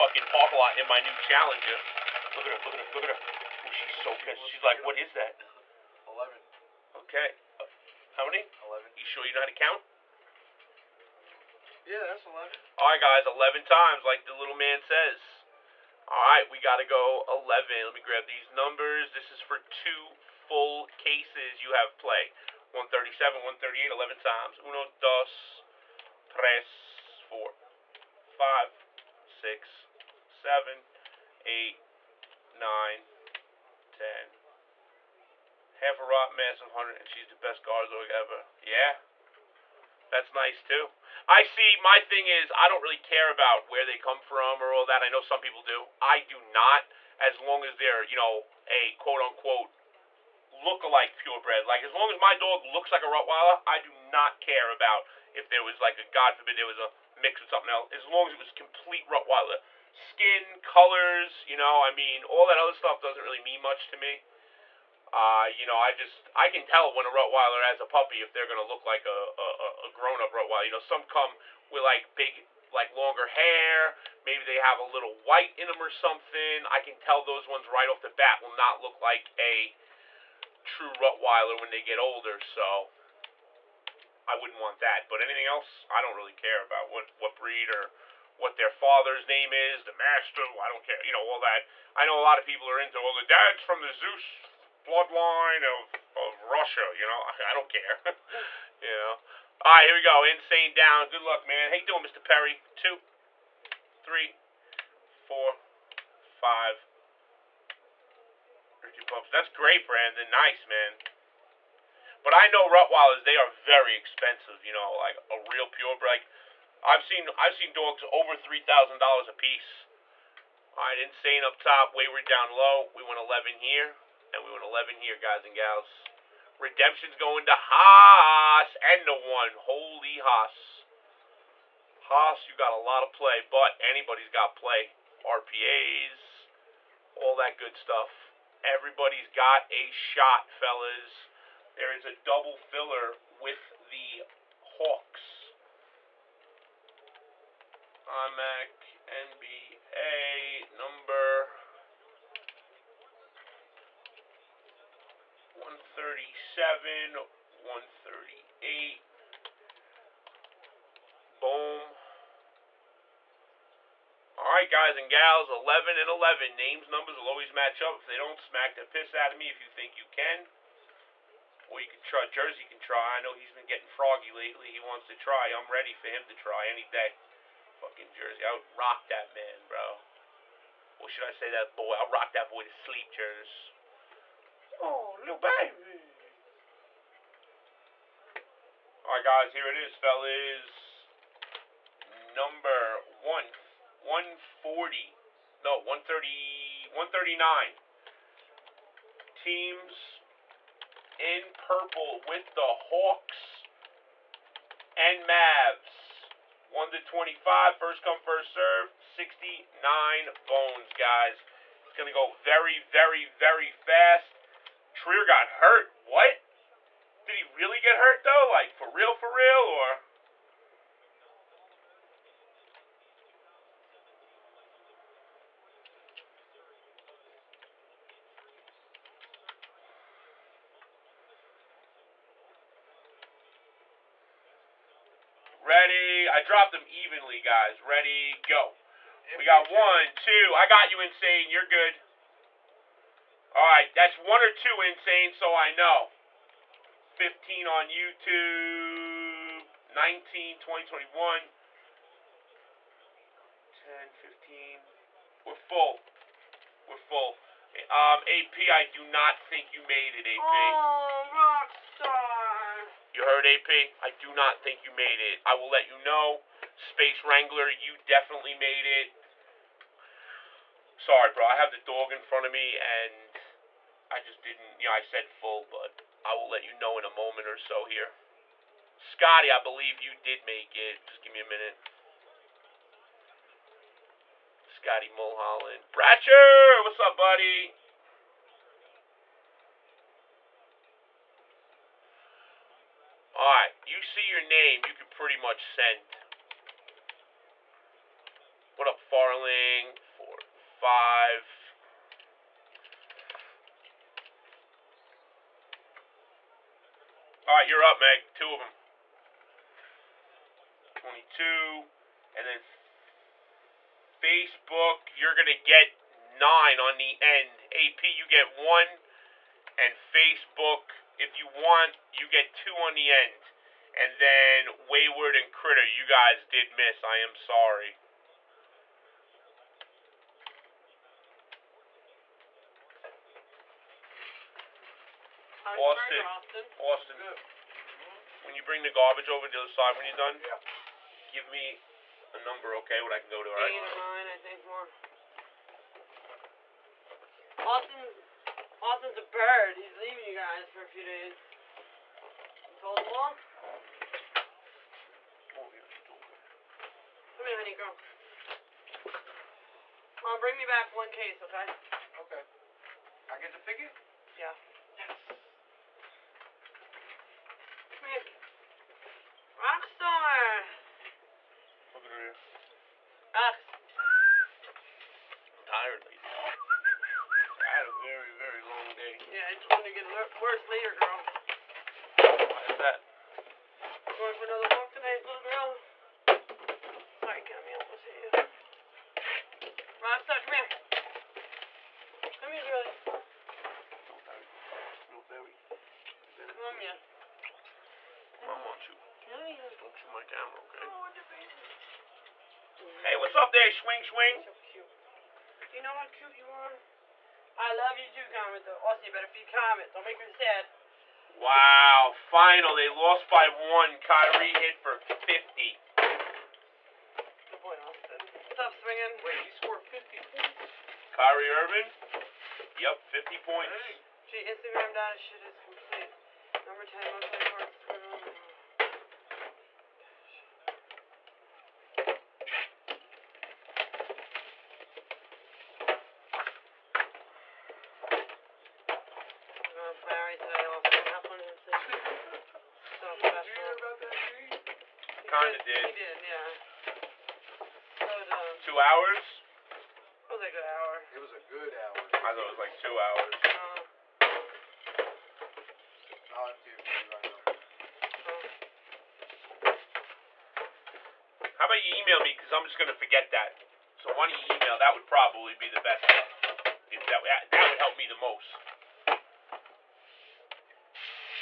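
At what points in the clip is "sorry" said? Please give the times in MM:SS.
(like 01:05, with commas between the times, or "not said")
04:30, 05:27, 06:27.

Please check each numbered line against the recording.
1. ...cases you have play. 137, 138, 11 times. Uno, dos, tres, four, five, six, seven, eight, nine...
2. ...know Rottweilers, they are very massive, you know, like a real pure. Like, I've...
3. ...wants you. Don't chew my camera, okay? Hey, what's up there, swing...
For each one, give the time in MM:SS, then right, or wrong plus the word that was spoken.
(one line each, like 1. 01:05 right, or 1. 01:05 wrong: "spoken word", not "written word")
1. 00:20 right
2. 01:52 wrong: "expensive", not "massive"
3. 06:38 right.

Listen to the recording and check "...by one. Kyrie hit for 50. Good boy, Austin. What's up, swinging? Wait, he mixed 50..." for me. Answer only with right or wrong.
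wrong.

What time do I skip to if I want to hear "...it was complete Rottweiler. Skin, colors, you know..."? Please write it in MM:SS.
00:58.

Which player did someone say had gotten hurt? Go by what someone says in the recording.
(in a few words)
Trier.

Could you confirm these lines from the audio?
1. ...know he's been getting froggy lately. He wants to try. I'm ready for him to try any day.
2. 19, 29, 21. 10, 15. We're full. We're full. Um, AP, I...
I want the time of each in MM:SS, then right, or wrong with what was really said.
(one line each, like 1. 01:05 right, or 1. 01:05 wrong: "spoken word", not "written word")
1. 02:53 right
2. 04:09 wrong: "20", not "29".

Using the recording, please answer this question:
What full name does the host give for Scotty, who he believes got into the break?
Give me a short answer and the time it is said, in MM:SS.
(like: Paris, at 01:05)
Scotty Mulholland, at 04:44.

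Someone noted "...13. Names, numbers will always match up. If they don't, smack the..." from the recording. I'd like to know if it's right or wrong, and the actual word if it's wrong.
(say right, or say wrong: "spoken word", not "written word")
wrong: "11", not "13".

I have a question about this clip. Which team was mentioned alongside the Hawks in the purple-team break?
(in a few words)
Mavs.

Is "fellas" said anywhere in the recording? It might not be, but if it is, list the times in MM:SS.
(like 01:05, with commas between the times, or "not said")
02:20, 03:09.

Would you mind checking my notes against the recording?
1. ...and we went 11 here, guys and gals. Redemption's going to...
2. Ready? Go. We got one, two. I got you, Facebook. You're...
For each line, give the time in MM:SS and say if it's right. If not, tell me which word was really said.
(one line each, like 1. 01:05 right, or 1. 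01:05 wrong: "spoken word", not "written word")
1. 02:04 right
2. 03:57 wrong: "Insane", not "Facebook".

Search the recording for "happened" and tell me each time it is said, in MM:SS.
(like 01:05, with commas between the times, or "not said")
07:21.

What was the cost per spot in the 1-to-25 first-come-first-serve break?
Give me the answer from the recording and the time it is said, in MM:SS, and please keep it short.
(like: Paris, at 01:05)
69, at 03:28.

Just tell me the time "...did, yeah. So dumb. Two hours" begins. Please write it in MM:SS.
07:25.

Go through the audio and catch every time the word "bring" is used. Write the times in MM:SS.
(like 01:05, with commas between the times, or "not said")
05:38, 06:00.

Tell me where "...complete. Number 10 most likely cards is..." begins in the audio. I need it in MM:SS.
07:05.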